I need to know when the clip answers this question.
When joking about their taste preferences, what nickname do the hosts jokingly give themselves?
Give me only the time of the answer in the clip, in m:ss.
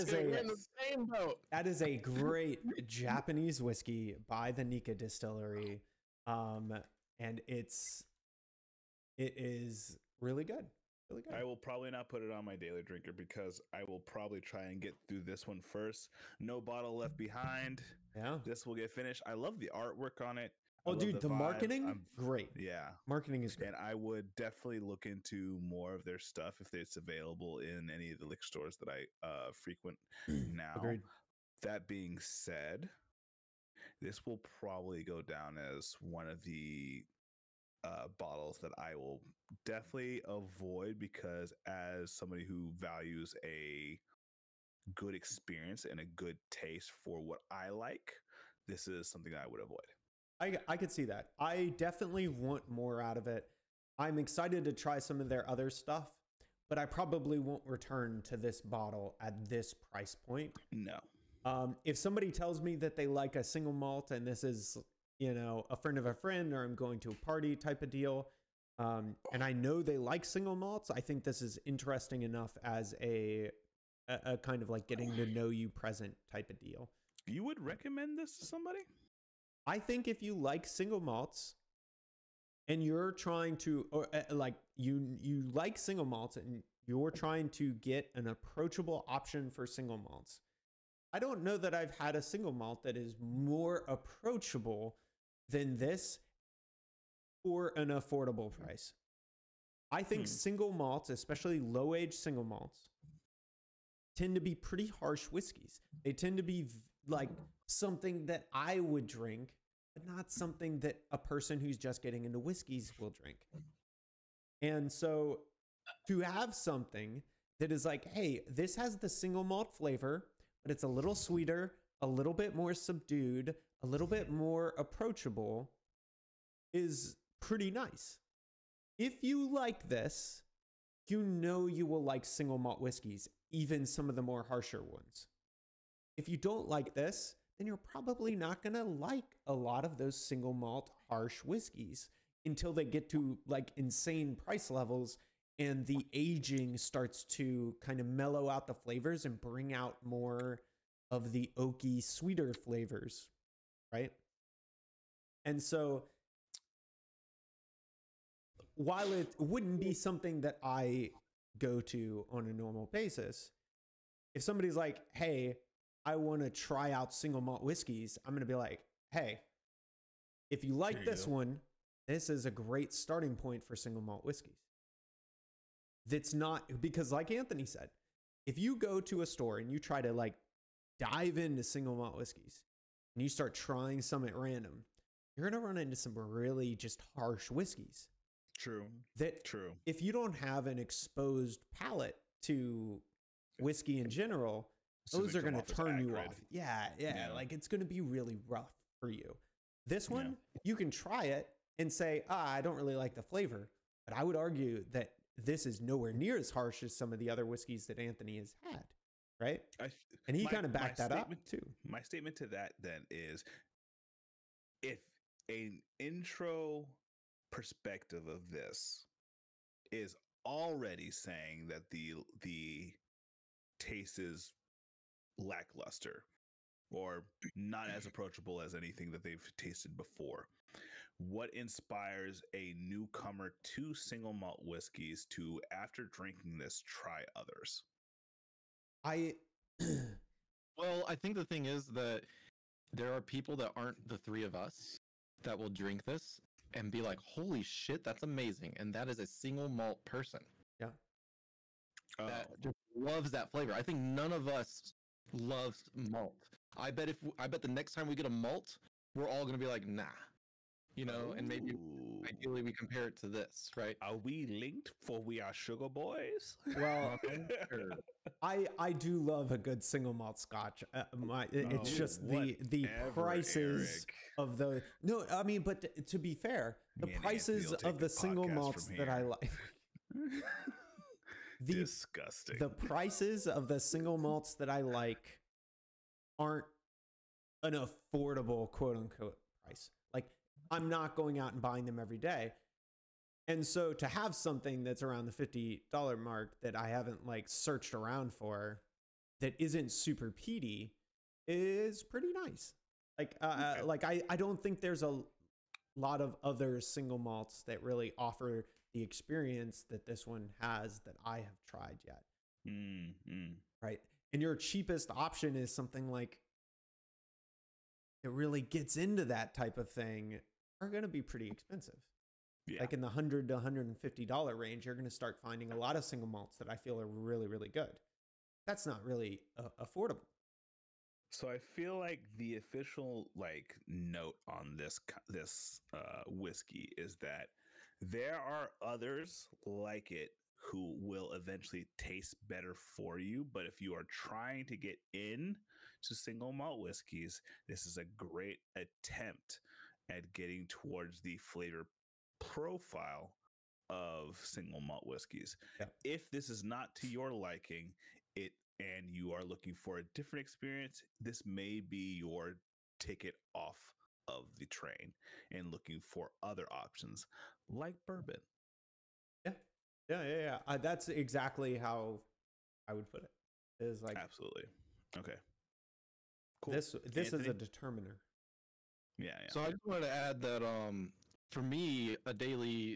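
4:25.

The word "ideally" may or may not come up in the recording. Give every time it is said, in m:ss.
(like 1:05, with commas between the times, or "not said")
4:22.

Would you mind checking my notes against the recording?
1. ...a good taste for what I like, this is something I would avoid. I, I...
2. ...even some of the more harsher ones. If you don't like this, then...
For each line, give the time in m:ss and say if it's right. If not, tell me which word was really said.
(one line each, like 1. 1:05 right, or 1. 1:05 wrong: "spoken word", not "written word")
1. 0:45 right
2. 2:13 right.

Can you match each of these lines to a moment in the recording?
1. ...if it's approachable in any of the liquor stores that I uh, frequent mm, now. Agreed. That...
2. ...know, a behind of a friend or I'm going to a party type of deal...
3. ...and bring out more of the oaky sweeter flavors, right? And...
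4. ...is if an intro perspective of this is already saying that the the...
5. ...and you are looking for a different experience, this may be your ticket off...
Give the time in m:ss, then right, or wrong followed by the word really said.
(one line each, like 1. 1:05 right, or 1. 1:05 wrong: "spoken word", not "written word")
1. 0:26 wrong: "available", not "approachable"
2. 1:05 wrong: "friend", not "behind"
3. 2:29 right
4. 3:33 right
5. 5:58 right.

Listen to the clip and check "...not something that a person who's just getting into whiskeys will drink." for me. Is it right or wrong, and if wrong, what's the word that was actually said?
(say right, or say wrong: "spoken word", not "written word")
right.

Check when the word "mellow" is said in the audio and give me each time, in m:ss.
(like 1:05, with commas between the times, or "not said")
2:28.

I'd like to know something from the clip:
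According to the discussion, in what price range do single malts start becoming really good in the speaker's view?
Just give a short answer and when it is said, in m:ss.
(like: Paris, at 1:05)
$100 to $150, at 5:23.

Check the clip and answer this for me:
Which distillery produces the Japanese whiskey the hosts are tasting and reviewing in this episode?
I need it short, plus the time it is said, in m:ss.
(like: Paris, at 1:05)
Nikka, at 0:04.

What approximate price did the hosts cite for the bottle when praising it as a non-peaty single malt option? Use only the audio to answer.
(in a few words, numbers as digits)
$50.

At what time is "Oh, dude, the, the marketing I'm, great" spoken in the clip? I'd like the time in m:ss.
0:20.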